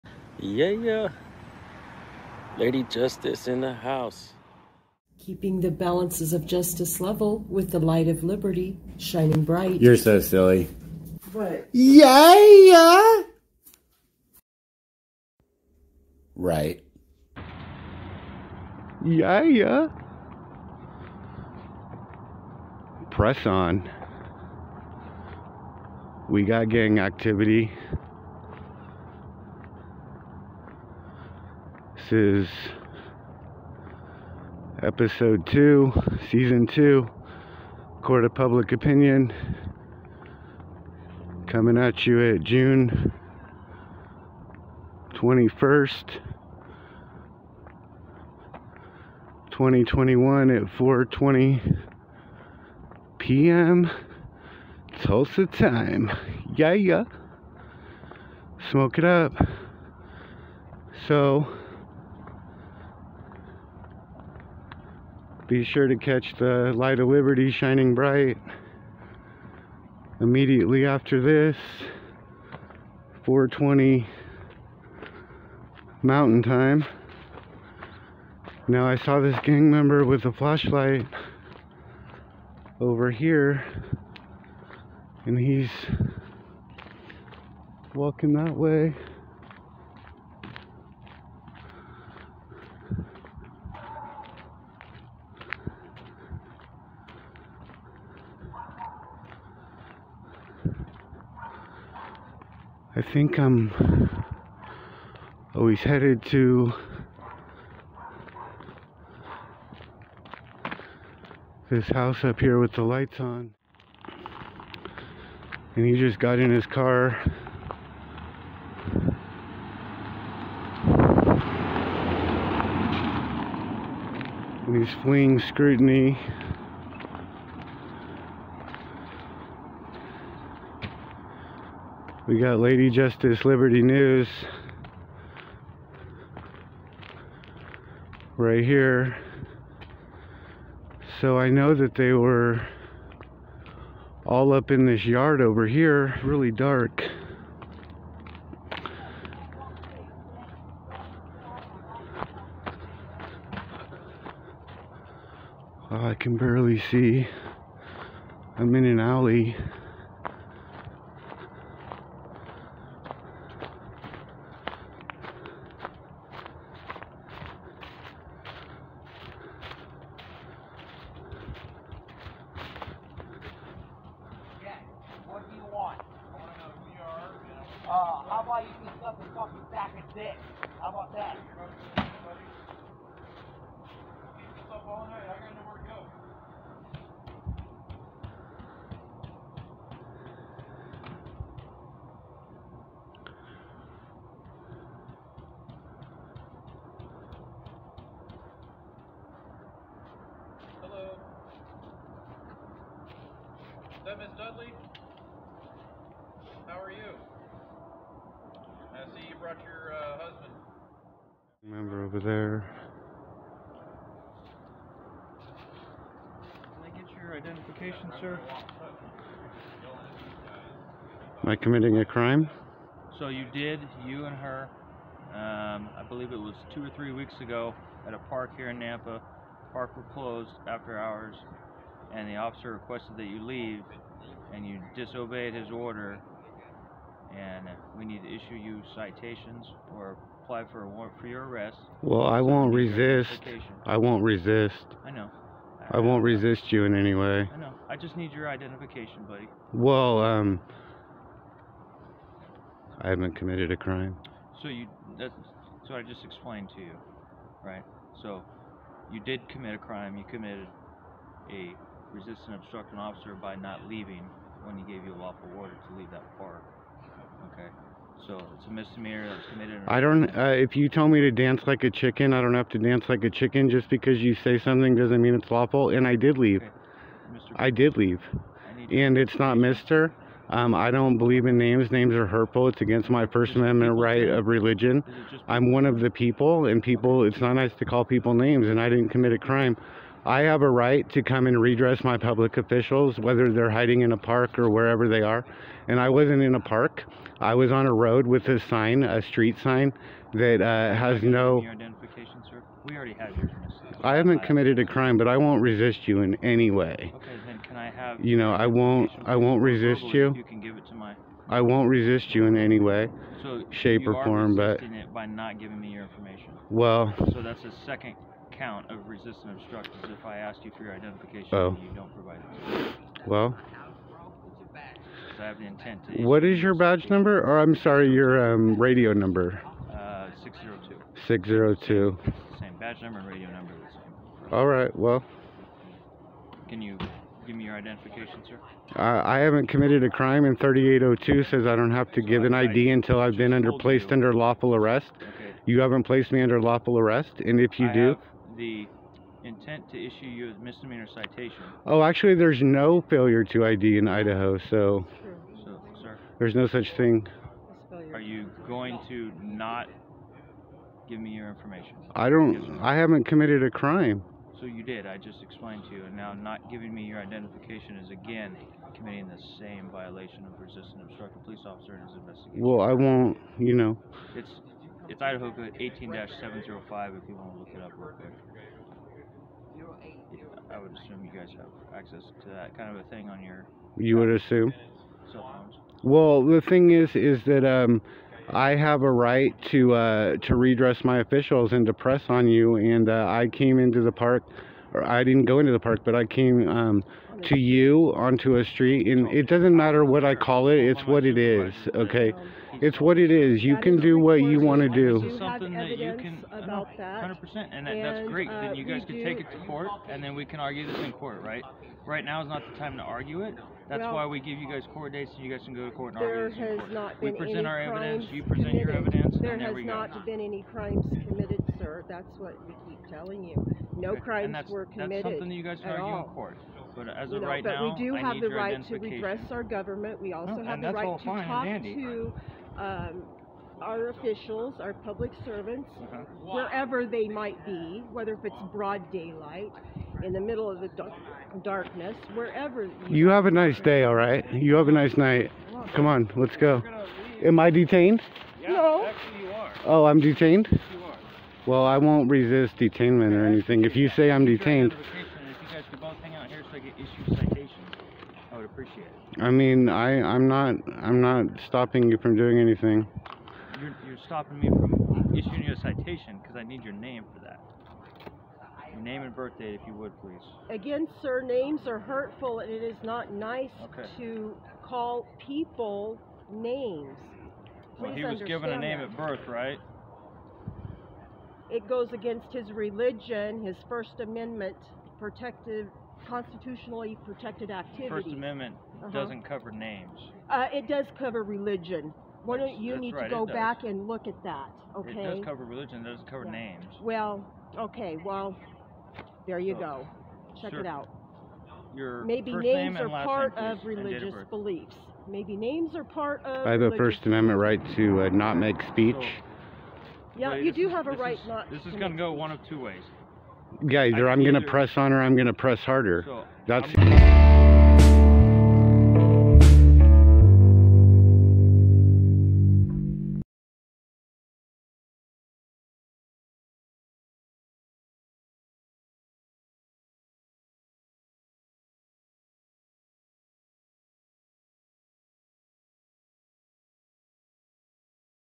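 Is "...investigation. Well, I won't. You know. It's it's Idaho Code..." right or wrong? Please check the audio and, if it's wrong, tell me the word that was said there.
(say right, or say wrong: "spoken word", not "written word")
right.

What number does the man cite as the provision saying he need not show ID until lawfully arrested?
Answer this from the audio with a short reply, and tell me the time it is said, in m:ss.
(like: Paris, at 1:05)
3802, at 5:40.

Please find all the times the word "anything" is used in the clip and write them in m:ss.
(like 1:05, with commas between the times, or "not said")
7:33, 7:42.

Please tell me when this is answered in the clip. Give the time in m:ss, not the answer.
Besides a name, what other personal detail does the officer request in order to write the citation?
7:49.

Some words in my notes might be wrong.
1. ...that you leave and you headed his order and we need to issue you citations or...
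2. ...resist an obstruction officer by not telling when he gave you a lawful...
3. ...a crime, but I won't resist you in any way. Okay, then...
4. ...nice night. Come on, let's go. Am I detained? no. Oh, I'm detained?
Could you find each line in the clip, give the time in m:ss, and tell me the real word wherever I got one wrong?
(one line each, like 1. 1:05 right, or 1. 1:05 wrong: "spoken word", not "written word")
1. 3:53 wrong: "disobeyed", not "headed"
2. 4:22 wrong: "leaving", not "telling"
3. 5:04 right
4. 7:24 right.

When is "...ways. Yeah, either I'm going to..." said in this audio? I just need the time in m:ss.
8:32.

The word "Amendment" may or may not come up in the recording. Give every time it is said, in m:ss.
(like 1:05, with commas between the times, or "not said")
4:43, 8:04, 8:08, 8:27.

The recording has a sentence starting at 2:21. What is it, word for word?
So I know that they were all up in this yard over here, really dark.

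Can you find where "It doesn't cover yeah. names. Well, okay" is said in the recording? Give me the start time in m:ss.
8:16.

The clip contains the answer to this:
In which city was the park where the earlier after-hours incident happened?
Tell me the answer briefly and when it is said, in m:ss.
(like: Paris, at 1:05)
Nampa, at 3:48.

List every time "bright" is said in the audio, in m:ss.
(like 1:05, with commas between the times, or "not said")
0:09, 1:07.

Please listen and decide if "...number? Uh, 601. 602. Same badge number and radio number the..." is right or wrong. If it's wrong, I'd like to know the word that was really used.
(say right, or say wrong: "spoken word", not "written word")
wrong: "602", not "601".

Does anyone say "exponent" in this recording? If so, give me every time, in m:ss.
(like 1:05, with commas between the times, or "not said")
not said.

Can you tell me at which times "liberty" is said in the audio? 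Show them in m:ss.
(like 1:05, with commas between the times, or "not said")
0:08, 1:07, 2:13.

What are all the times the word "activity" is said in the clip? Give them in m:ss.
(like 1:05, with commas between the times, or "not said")
0:26, 8:07.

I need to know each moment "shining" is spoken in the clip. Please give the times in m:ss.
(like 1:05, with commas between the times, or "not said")
0:08, 1:07.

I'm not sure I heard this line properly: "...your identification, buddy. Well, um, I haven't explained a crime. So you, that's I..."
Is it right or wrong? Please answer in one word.
wrong.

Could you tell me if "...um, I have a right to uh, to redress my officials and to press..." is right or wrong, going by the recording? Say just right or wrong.
right.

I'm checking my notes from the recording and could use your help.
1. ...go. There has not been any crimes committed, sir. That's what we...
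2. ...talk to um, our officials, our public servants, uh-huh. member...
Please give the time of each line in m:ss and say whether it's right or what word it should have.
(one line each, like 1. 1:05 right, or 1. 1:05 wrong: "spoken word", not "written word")
1. 6:59 right
2. 7:11 wrong: "wherever", not "member".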